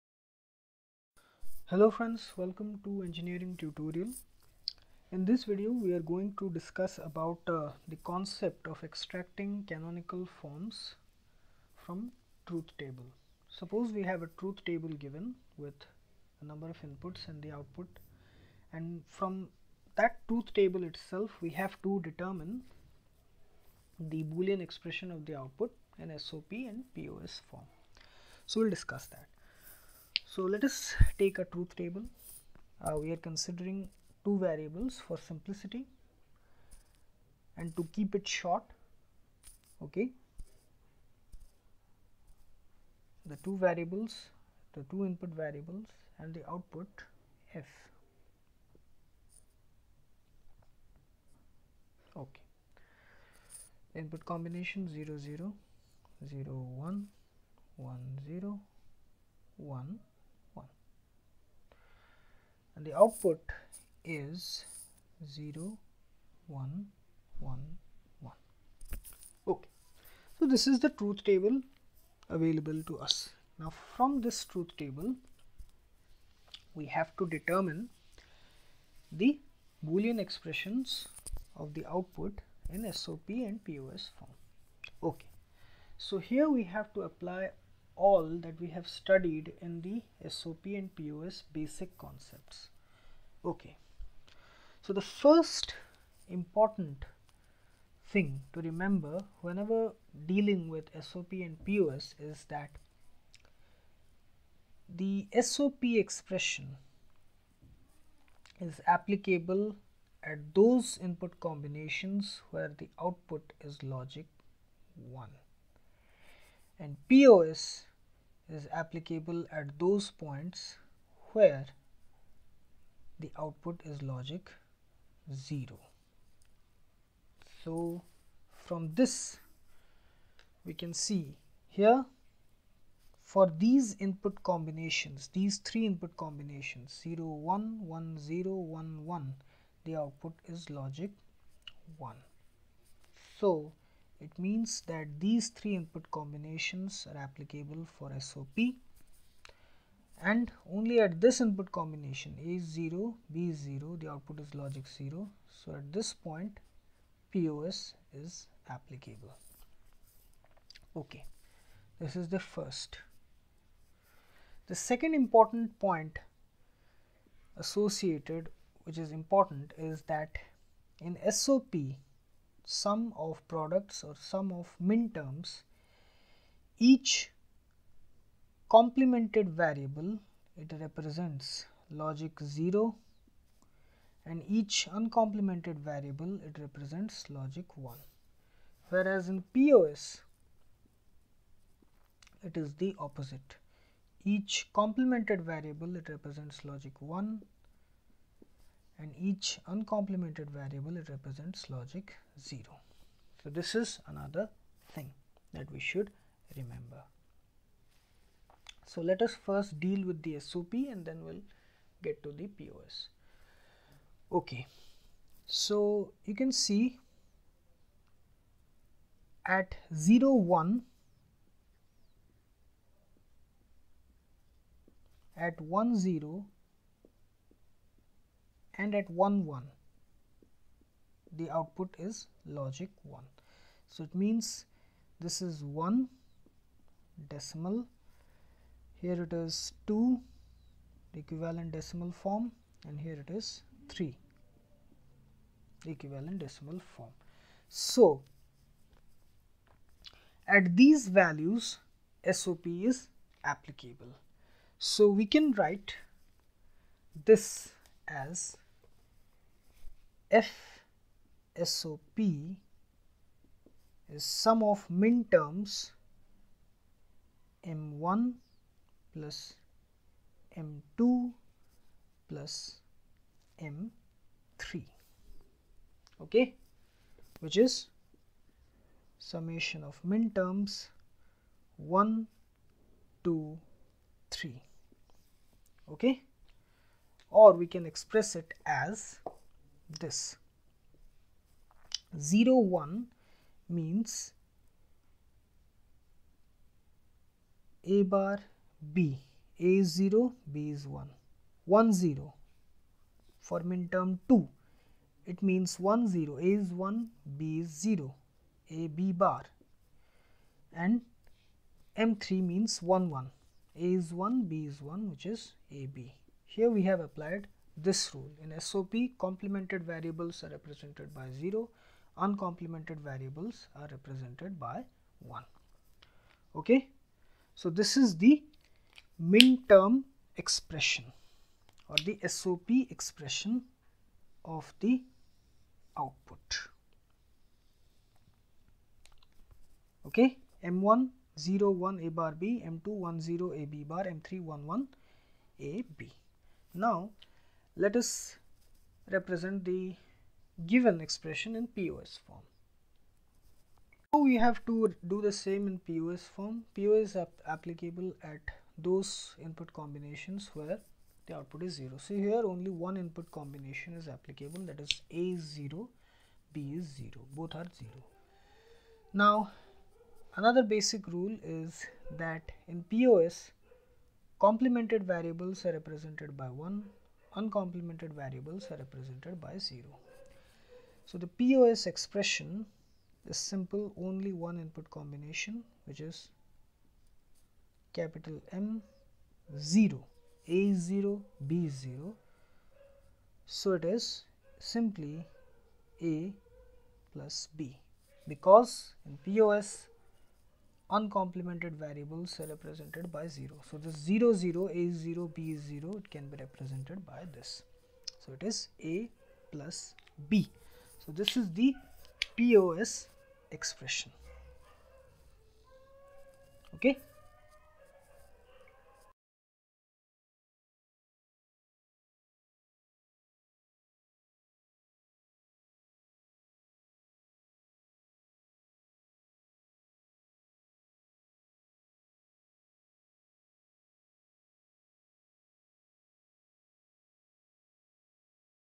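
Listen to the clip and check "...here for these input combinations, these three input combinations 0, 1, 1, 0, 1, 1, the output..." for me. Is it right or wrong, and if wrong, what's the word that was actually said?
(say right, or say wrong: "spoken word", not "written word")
right.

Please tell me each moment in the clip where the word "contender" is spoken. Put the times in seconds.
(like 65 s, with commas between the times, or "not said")
not said.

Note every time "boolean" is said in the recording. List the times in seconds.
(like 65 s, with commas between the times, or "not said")
24 s, 79 s.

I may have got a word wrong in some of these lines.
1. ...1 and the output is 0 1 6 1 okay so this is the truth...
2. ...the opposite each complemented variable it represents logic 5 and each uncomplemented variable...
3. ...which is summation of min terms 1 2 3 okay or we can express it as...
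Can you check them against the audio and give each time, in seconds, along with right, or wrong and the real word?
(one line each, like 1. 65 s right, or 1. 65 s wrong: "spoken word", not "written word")
1. 59 s wrong: "1", not "6"
2. 192 s wrong: "1", not "5"
3. 277 s right.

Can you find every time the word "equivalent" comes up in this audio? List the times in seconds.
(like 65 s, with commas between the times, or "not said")
241 s, 245 s.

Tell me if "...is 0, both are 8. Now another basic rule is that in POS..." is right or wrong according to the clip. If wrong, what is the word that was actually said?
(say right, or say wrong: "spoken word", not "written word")
wrong: "0", not "8".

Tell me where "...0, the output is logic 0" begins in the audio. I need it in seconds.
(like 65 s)
153 s.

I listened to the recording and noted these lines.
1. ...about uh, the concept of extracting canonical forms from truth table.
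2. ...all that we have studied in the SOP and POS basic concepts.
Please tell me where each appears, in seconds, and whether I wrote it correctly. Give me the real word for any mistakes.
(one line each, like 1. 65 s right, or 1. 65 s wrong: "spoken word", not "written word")
1. 7 s right
2. 87 s right.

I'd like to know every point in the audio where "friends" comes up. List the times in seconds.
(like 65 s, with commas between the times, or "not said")
1 s.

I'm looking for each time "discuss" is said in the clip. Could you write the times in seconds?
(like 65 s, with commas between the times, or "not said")
6 s, 28 s.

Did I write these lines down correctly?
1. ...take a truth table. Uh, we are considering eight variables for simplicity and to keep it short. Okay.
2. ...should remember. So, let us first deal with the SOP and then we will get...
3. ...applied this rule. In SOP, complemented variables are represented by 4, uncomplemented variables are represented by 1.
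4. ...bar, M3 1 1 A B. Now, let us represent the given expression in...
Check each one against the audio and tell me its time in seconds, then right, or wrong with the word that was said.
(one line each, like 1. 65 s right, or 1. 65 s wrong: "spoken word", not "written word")
1. 31 s wrong: "two", not "eight"
2. 205 s right
3. 317 s wrong: "0", not "4"
4. 343 s right.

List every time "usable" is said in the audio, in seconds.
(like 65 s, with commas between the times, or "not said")
not said.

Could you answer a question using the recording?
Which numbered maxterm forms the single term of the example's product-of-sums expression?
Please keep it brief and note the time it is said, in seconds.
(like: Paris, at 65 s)
M0, at 387 s.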